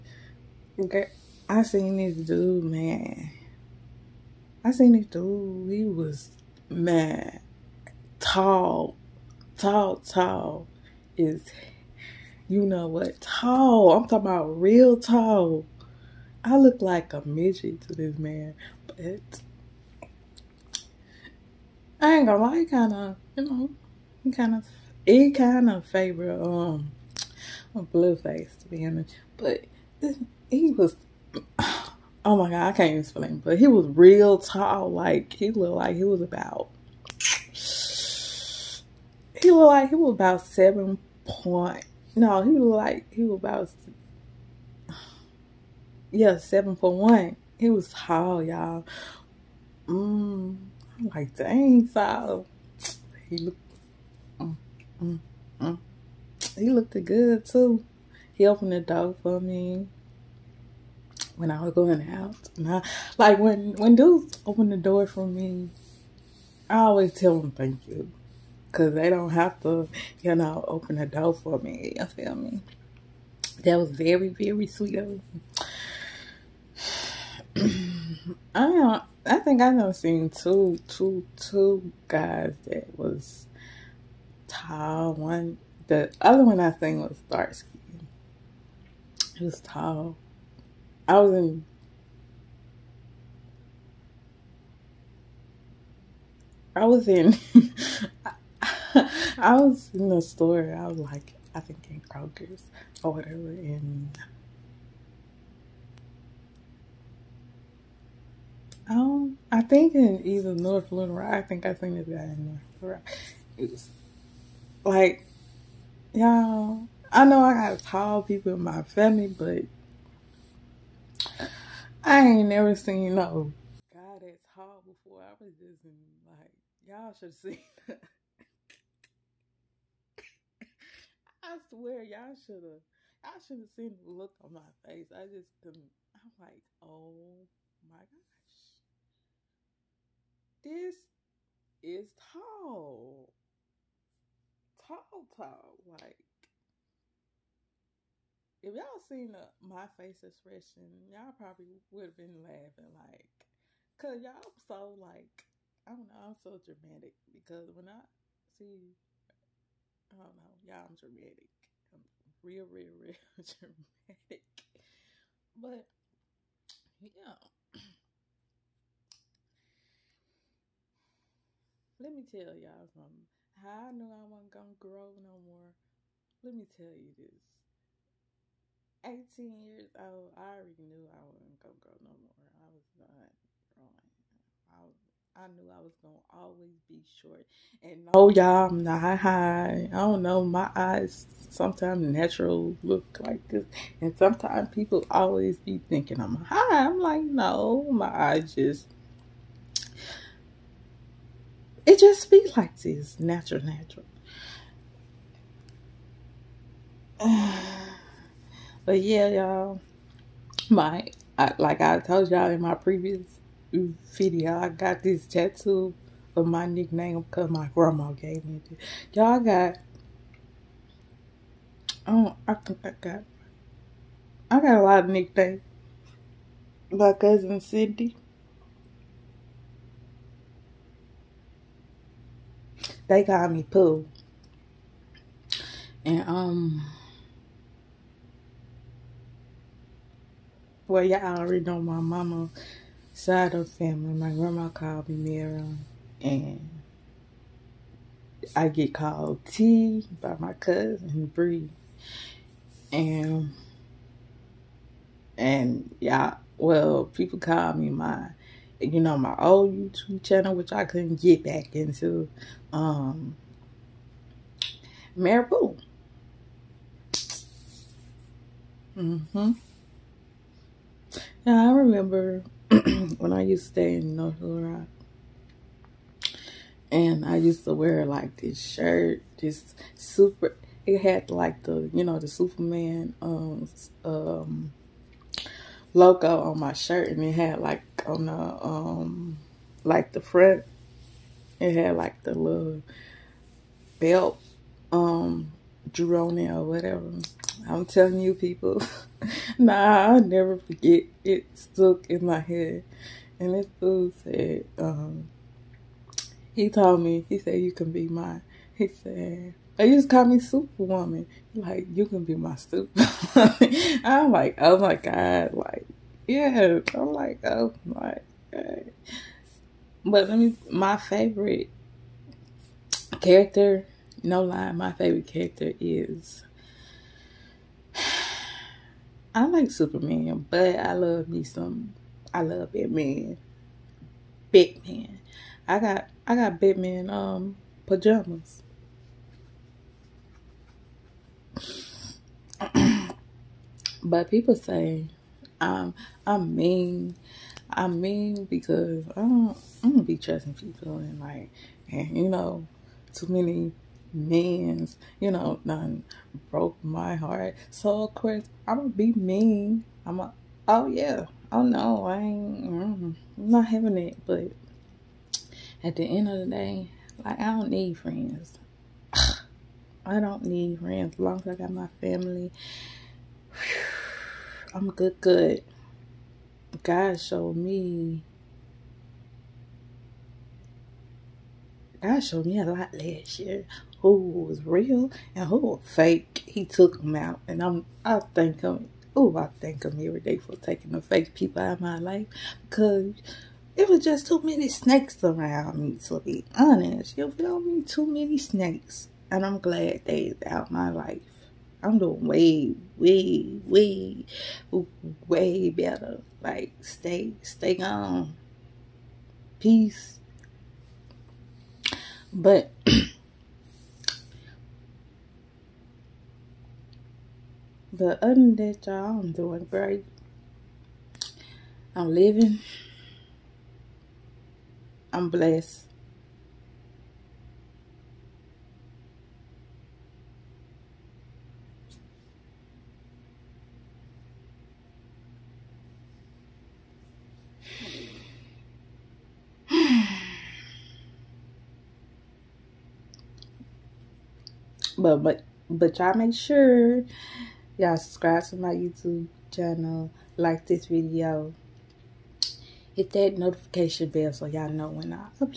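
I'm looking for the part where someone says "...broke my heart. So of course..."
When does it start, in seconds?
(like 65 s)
356 s.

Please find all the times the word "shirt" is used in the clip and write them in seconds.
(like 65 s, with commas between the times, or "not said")
278 s, 286 s.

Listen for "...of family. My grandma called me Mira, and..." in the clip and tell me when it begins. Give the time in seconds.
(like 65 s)
243 s.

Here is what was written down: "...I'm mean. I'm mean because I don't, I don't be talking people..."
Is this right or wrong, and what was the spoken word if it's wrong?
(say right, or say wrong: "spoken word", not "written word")
wrong: "trusting", not "talking".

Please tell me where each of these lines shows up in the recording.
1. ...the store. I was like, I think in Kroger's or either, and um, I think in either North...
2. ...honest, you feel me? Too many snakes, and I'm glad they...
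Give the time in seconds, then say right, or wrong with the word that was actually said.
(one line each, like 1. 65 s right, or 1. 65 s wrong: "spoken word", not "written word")
1. 100 s wrong: "whatever", not "either"
2. 396 s right.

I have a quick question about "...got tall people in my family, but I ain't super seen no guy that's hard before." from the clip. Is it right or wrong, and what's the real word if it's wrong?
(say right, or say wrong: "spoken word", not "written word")
wrong: "never", not "super".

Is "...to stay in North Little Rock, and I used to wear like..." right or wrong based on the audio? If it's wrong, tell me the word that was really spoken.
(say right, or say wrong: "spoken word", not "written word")
right.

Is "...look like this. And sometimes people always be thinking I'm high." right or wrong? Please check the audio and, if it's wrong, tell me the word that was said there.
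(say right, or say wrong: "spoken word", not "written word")
right.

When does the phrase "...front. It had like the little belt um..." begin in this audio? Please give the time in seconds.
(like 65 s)
290 s.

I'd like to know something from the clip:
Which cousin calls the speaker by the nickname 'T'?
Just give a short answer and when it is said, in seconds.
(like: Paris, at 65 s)
Bree, at 251 s.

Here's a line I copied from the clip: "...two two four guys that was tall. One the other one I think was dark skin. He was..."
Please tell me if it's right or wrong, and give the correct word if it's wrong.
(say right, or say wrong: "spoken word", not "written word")
wrong: "two", not "four".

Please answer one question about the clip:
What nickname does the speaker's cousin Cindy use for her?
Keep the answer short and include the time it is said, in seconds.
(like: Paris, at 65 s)
Pooh, at 233 s.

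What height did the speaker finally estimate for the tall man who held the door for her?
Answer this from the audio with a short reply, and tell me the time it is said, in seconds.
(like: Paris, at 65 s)
7.1, at 46 s.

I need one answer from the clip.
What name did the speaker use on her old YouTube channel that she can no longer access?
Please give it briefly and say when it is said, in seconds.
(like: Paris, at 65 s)
Marabou, at 265 s.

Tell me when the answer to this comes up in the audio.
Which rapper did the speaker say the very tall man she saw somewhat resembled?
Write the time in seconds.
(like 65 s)
27 s.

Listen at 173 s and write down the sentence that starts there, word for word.
How I knew I wasn't gonna grow no more.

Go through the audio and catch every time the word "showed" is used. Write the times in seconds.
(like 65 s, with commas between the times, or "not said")
377 s, 382 s.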